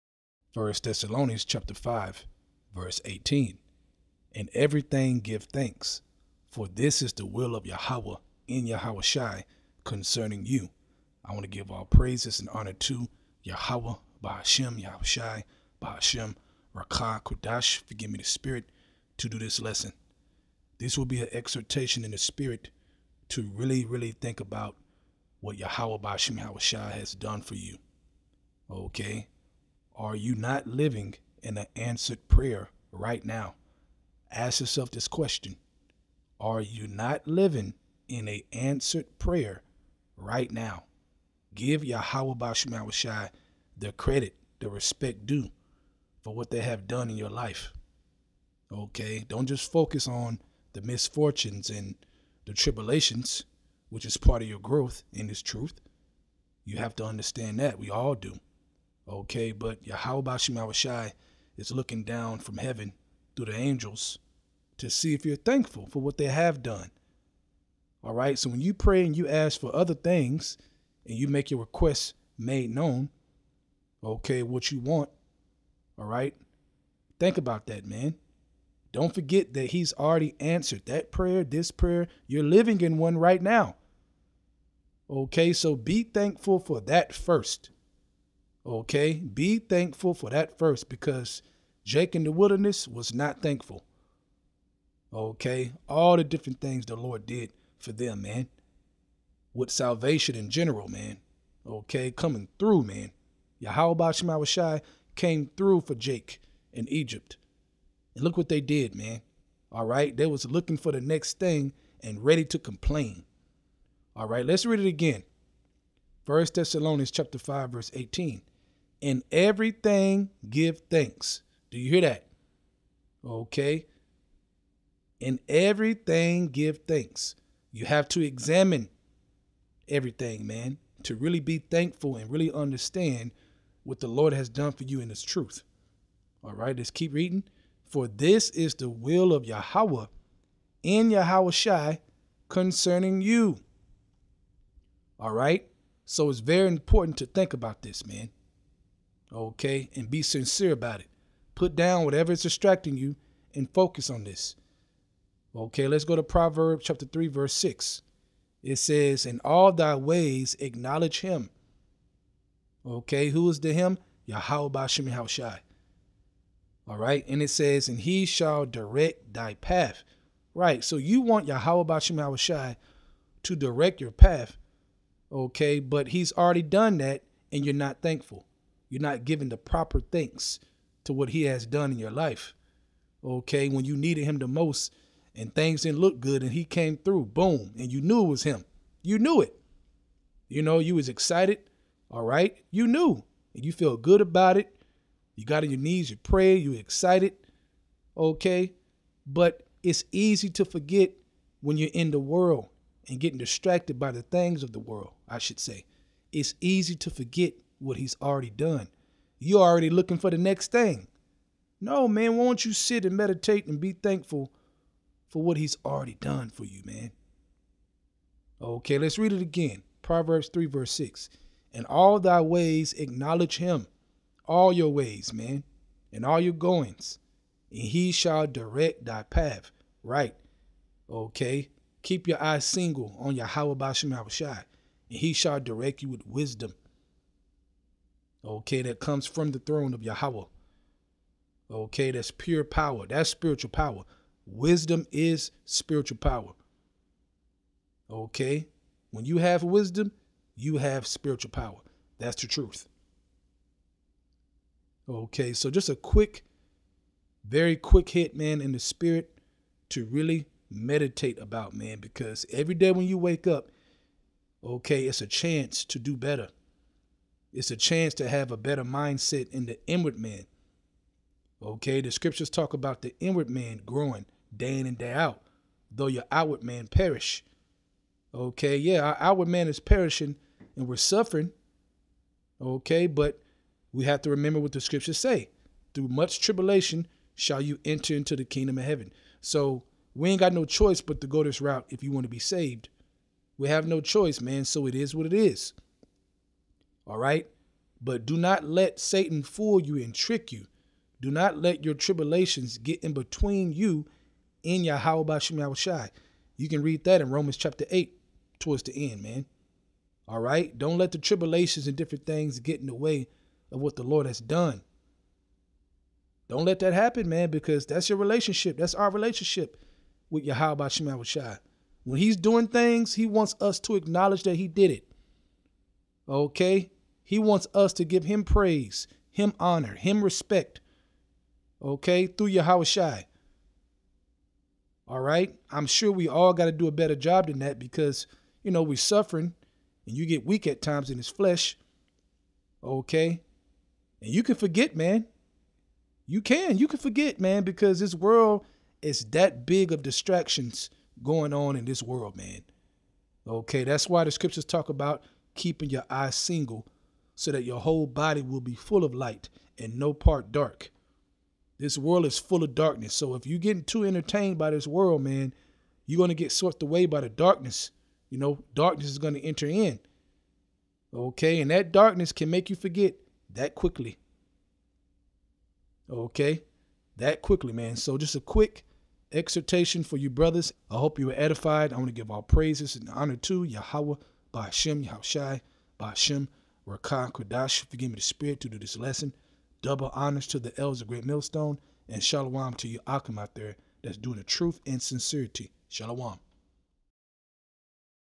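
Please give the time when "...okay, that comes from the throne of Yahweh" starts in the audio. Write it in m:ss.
3:58.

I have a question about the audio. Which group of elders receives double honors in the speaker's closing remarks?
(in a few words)
Great Millstone.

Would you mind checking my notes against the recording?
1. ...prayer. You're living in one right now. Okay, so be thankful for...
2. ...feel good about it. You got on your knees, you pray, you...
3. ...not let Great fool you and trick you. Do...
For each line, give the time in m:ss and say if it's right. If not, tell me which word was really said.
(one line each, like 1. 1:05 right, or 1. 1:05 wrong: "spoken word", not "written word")
1. 1:21 right
2. 3:13 right
3. 4:58 wrong: "Satan", not "Great".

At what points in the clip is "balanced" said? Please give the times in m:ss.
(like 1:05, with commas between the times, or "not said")
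not said.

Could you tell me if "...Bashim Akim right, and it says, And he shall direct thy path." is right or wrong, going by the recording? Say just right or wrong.
wrong.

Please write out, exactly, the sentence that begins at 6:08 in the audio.
You know, darkness is going to enter in.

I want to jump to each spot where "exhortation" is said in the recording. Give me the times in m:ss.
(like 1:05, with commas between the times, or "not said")
0:21, 6:19.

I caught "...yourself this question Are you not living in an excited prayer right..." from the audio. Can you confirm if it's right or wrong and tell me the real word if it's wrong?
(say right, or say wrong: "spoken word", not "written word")
wrong: "answered", not "excited".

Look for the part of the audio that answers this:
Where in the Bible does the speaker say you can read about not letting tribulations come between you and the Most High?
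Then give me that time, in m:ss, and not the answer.
5:07.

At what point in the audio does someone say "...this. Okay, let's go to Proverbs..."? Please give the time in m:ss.
2:34.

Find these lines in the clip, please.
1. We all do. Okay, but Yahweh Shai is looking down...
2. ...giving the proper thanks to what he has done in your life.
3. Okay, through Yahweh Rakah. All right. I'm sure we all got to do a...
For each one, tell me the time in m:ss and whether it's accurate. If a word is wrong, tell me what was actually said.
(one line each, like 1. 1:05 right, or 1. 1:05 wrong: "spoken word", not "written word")
1. 0:57 right
2. 2:59 right
3. 5:31 wrong: "Shai", not "Rakah".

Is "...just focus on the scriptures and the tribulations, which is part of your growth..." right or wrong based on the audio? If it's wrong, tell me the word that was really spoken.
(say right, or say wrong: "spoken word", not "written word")
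wrong: "misfortunes", not "scriptures".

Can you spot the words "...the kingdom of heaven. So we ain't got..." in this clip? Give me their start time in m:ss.
4:48.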